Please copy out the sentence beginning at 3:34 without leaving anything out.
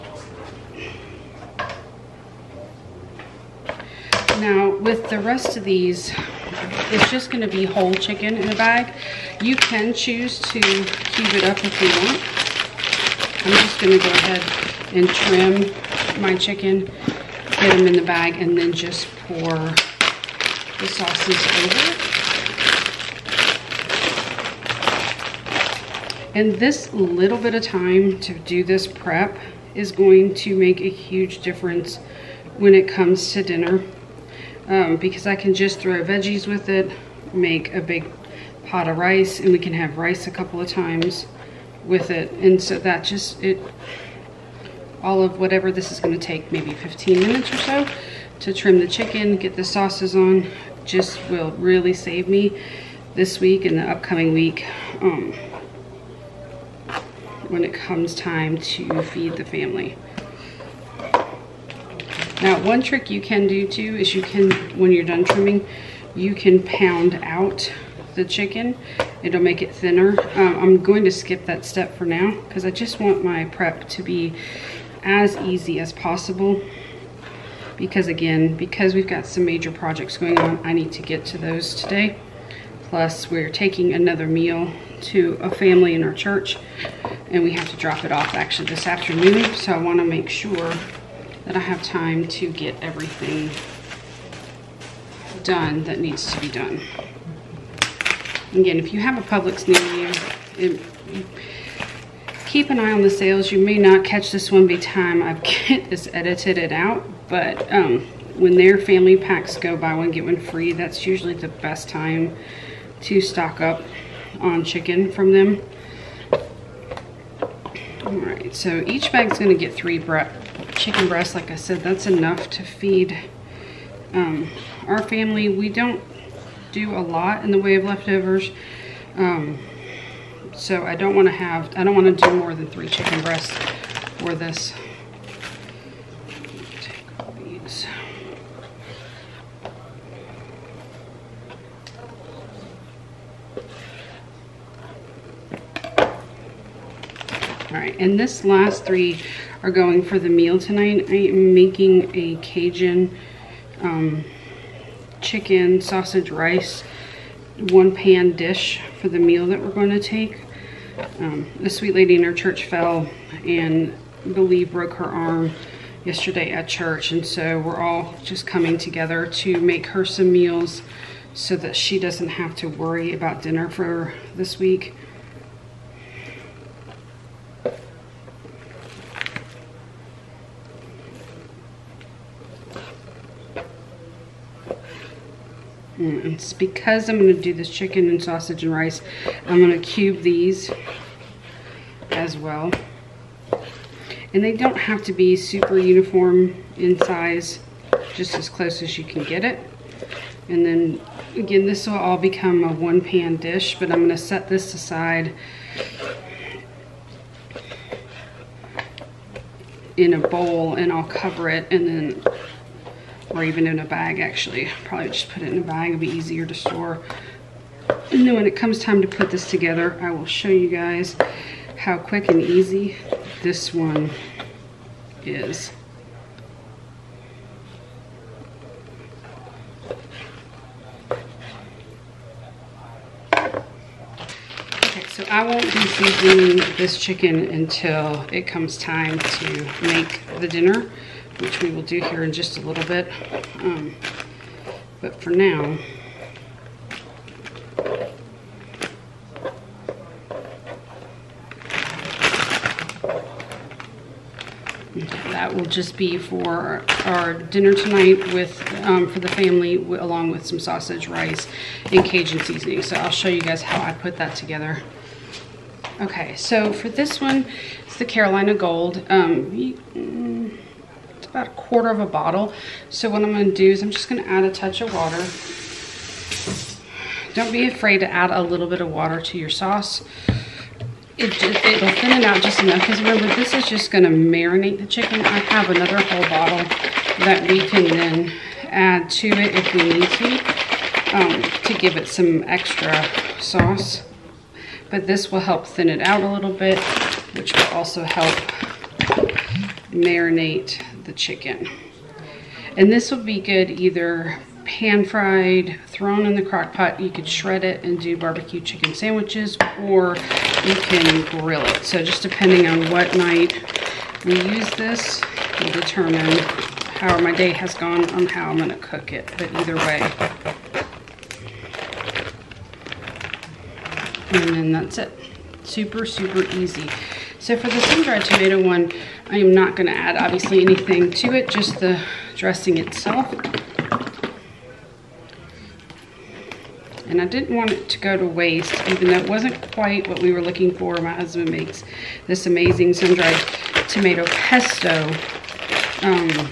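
Probably just put it in a bag, it will be easier to store.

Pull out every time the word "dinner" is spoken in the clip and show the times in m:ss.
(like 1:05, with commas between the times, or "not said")
0:33, 2:53, 4:00, 4:17.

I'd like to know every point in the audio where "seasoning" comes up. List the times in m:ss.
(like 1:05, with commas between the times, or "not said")
3:55, 4:22.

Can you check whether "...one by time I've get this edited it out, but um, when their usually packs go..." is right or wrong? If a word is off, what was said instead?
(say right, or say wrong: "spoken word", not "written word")
wrong: "family", not "usually".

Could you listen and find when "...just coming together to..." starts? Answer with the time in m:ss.
2:48.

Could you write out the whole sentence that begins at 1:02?
Now, one trick you can do too is you can, when you're done trimming, you can pound out the chicken.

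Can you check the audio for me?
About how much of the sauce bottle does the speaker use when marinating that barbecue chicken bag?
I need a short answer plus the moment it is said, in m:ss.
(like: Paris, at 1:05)
a quarter of a bottle, at 4:31.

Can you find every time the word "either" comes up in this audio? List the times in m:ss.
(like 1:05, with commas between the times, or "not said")
5:03, 5:19.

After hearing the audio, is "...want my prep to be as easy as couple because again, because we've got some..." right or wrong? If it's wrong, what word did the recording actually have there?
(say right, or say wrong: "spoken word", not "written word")
wrong: "possible", not "couple".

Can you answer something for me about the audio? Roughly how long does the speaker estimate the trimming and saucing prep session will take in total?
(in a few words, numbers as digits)
15 minutes.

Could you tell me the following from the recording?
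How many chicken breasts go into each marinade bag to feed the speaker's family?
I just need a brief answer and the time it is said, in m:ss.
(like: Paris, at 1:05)
3, at 1:59.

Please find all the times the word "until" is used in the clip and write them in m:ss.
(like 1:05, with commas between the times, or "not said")
3:57.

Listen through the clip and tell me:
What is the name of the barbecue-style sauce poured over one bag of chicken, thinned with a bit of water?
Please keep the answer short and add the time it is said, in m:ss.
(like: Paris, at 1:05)
Carolina Gold, at 4:28.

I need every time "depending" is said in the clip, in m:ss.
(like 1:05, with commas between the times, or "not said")
5:12.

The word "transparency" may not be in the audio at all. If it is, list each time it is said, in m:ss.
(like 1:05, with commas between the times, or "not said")
not said.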